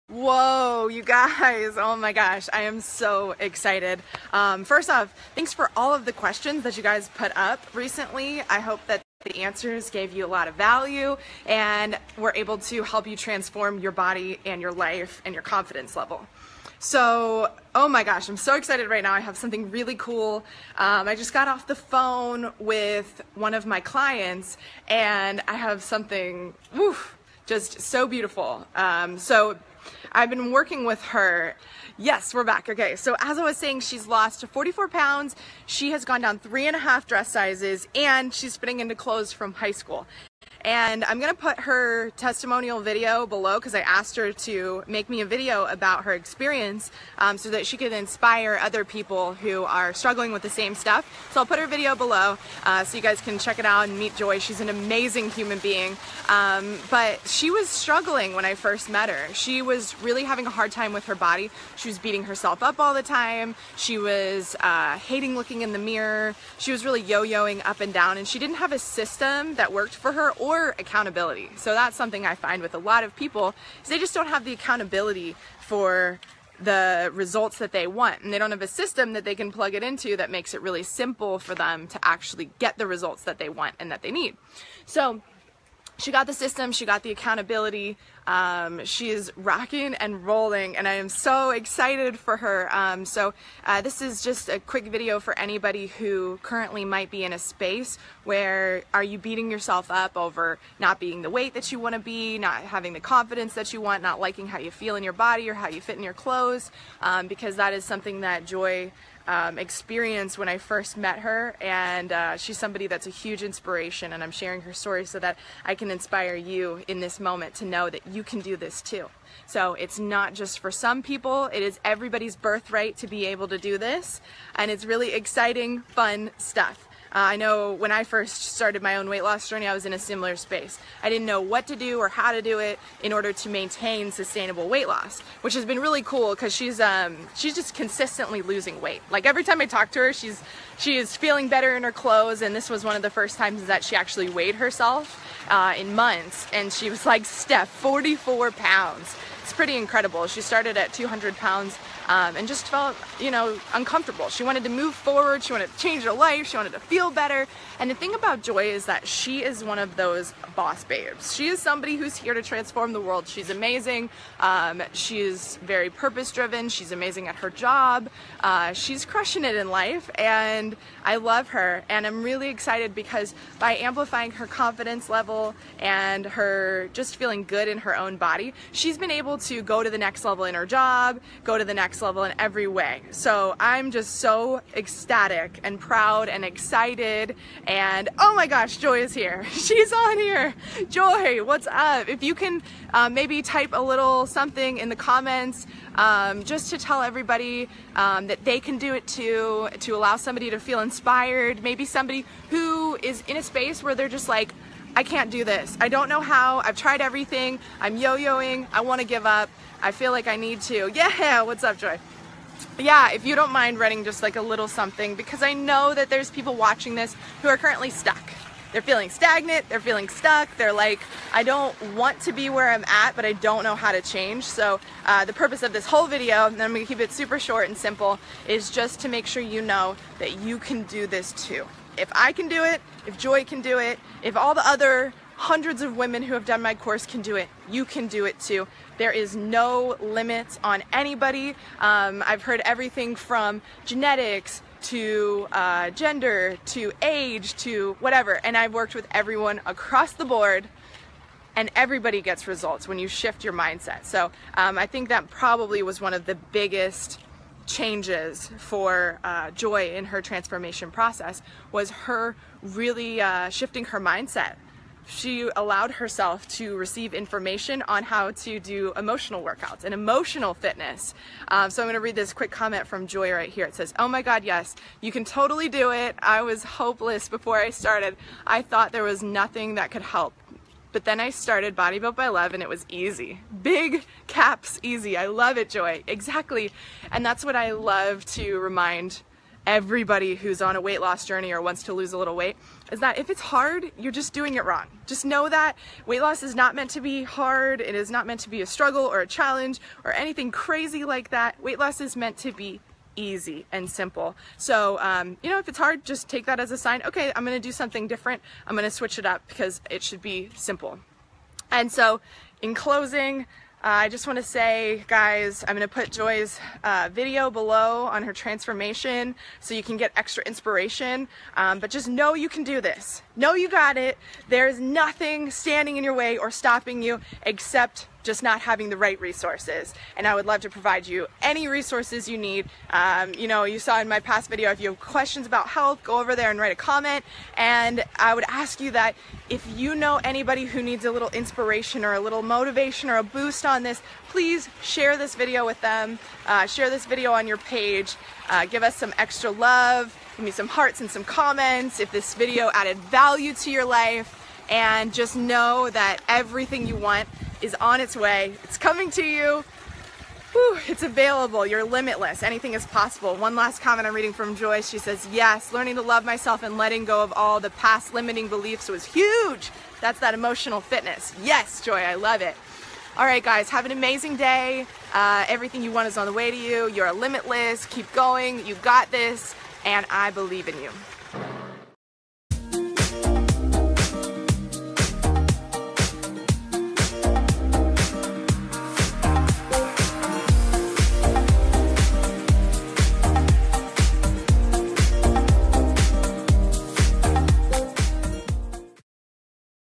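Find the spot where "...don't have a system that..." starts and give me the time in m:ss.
1:18.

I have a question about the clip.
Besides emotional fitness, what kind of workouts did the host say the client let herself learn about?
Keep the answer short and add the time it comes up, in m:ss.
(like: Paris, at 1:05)
Emotional workouts, at 4:28.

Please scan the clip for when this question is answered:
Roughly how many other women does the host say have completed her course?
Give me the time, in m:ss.
3:55.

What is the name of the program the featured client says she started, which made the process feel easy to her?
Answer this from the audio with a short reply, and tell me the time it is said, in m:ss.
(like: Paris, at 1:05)
Body Built by Love, at 4:41.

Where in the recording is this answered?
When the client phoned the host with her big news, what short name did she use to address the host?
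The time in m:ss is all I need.
2:27.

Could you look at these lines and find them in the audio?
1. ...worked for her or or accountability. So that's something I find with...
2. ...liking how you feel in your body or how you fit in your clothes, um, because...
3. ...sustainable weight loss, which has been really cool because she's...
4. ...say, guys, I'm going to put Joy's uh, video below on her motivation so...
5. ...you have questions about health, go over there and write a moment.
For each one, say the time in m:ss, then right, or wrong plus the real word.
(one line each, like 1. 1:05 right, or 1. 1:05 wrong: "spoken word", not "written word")
1. 1:09 right
2. 1:44 right
3. 2:14 right
4. 5:14 wrong: "transformation", not "motivation"
5. 5:34 wrong: "comment", not "moment".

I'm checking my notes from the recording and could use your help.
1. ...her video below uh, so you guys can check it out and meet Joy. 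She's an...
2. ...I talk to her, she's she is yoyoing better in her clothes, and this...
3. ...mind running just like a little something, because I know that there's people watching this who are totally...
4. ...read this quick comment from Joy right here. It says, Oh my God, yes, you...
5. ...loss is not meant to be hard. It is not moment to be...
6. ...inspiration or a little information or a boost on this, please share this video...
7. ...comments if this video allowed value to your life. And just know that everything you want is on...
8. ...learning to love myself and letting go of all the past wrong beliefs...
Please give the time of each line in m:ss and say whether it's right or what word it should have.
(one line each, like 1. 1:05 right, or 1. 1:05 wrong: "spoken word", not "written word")
1. 0:51 right
2. 2:19 wrong: "feeling", not "yoyoing"
3. 3:33 wrong: "currently", not "totally"
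4. 4:31 right
5. 4:56 wrong: "meant", not "moment"
6. 5:41 wrong: "motivation", not "information"
7. 5:51 wrong: "added", not "allowed"
8. 6:05 wrong: "limiting", not "wrong".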